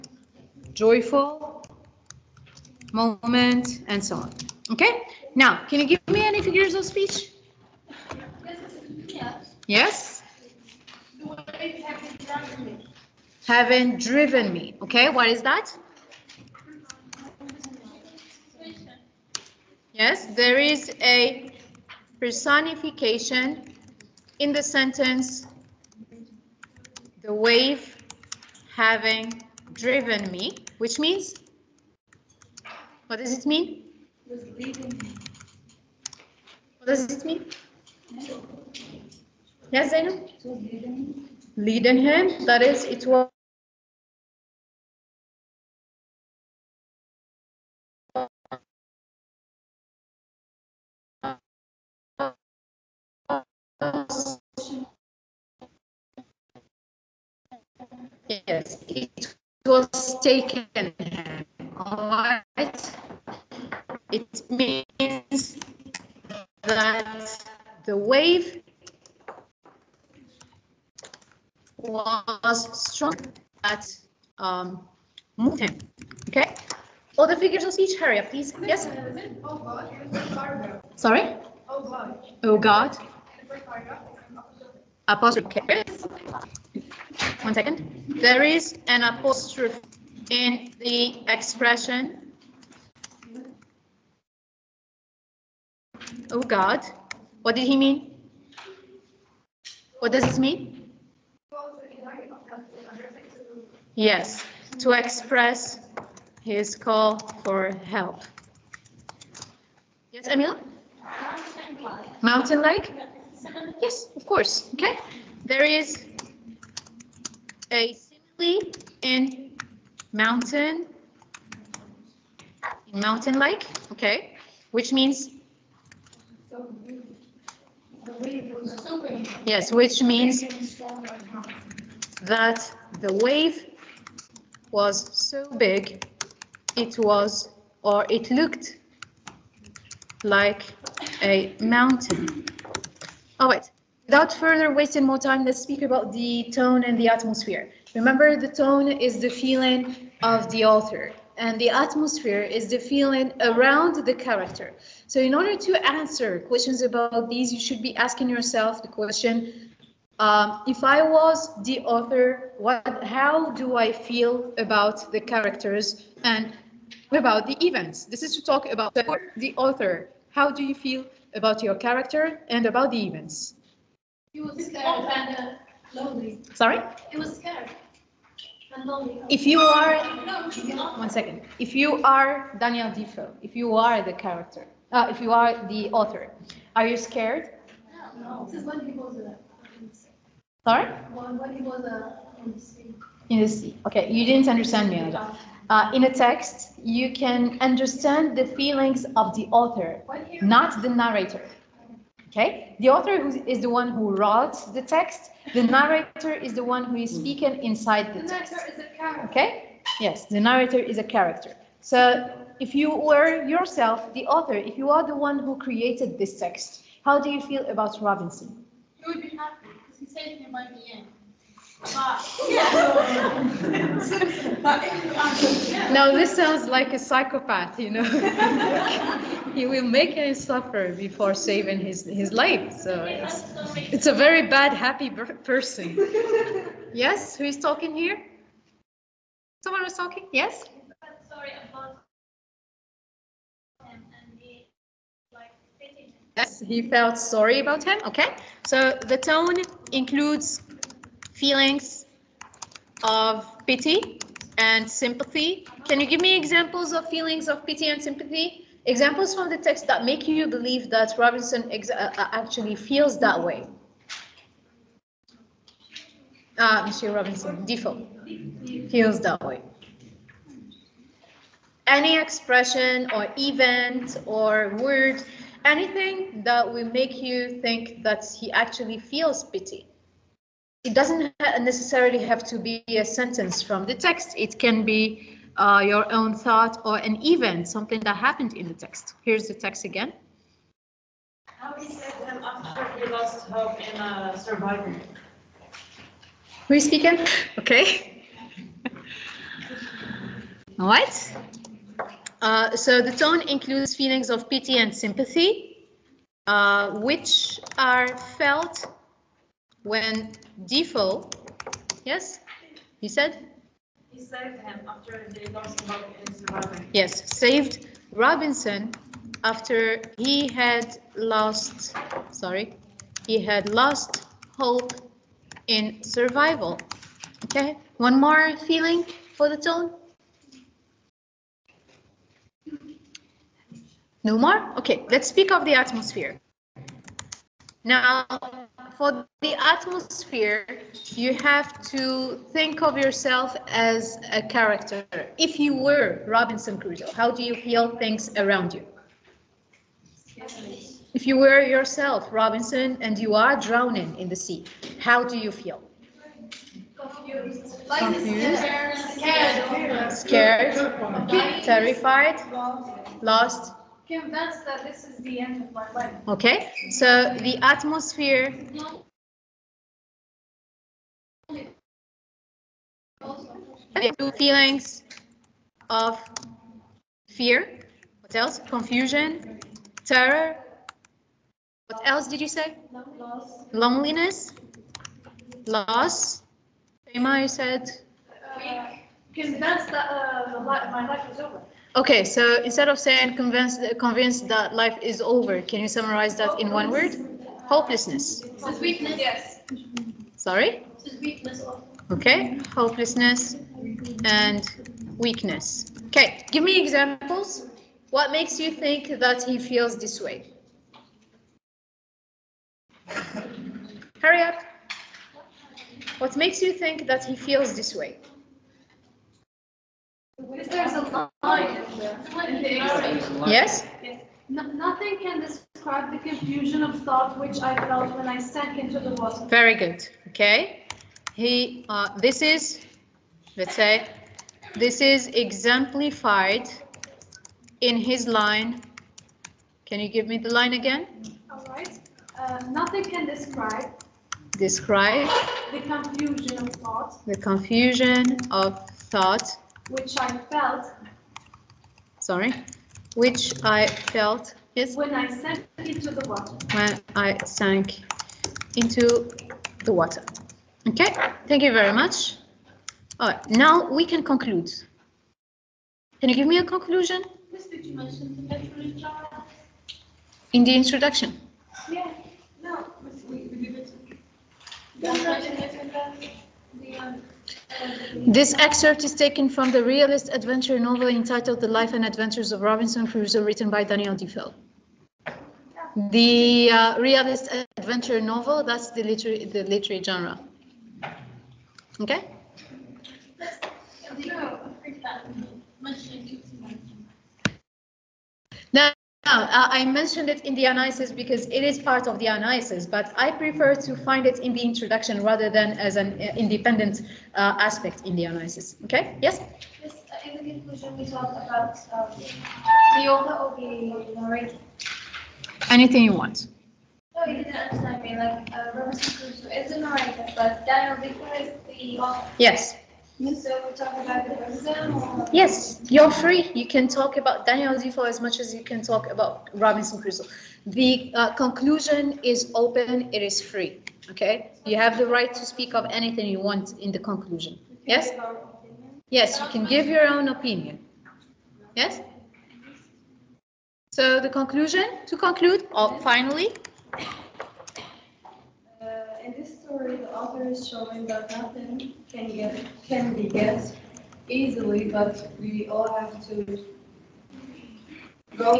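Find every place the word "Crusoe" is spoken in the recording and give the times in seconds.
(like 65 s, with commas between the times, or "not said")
346 s, 483 s, 519 s, 530 s.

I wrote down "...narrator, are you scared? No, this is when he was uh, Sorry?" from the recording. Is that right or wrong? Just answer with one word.
wrong.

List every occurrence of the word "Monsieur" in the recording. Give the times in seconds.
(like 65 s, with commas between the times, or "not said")
266 s.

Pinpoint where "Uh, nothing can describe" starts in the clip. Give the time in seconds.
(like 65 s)
442 s.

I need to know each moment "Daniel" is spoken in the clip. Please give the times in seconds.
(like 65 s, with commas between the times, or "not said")
182 s, 483 s, 520 s, 527 s.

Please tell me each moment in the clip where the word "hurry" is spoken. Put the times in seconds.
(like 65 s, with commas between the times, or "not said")
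77 s, 414 s.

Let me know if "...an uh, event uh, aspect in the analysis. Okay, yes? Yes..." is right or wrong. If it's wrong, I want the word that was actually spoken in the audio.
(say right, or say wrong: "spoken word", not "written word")
wrong: "independent", not "event".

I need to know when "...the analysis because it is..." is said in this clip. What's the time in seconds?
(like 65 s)
500 s.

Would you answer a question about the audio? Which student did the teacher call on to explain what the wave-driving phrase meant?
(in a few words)
Zainab.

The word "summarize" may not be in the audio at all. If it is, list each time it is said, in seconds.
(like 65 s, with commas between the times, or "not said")
395 s.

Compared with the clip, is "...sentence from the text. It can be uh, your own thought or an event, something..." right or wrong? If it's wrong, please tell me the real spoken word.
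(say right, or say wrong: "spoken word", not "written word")
right.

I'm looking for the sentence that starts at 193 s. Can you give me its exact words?
Okay, you didn't understand me, Uh, in a text, you can understand the feelings of the author, not the narrator.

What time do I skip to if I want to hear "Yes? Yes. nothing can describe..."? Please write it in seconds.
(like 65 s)
423 s.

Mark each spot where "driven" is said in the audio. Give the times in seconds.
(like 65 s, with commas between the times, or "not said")
14 s, 29 s.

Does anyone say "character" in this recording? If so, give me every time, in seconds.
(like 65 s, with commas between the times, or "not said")
154 s, 165 s, 171 s, 184 s, 211 s, 344 s.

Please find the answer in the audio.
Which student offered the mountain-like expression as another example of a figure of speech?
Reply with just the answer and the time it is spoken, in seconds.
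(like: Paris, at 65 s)
Emil, at 110 s.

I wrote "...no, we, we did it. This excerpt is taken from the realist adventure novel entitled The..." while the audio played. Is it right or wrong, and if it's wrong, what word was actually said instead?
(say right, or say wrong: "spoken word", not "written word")
right.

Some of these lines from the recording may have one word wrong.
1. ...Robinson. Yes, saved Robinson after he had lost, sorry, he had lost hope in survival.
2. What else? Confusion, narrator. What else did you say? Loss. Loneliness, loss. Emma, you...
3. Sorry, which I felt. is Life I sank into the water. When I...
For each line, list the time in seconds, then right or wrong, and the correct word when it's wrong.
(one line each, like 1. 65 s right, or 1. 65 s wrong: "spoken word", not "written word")
1. 315 s right
2. 378 s wrong: "terror", not "narrator"
3. 452 s wrong: "When", not "Life".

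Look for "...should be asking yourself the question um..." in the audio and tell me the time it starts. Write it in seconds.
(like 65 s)
157 s.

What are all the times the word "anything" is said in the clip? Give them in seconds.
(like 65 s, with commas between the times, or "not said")
275 s, 515 s, 535 s.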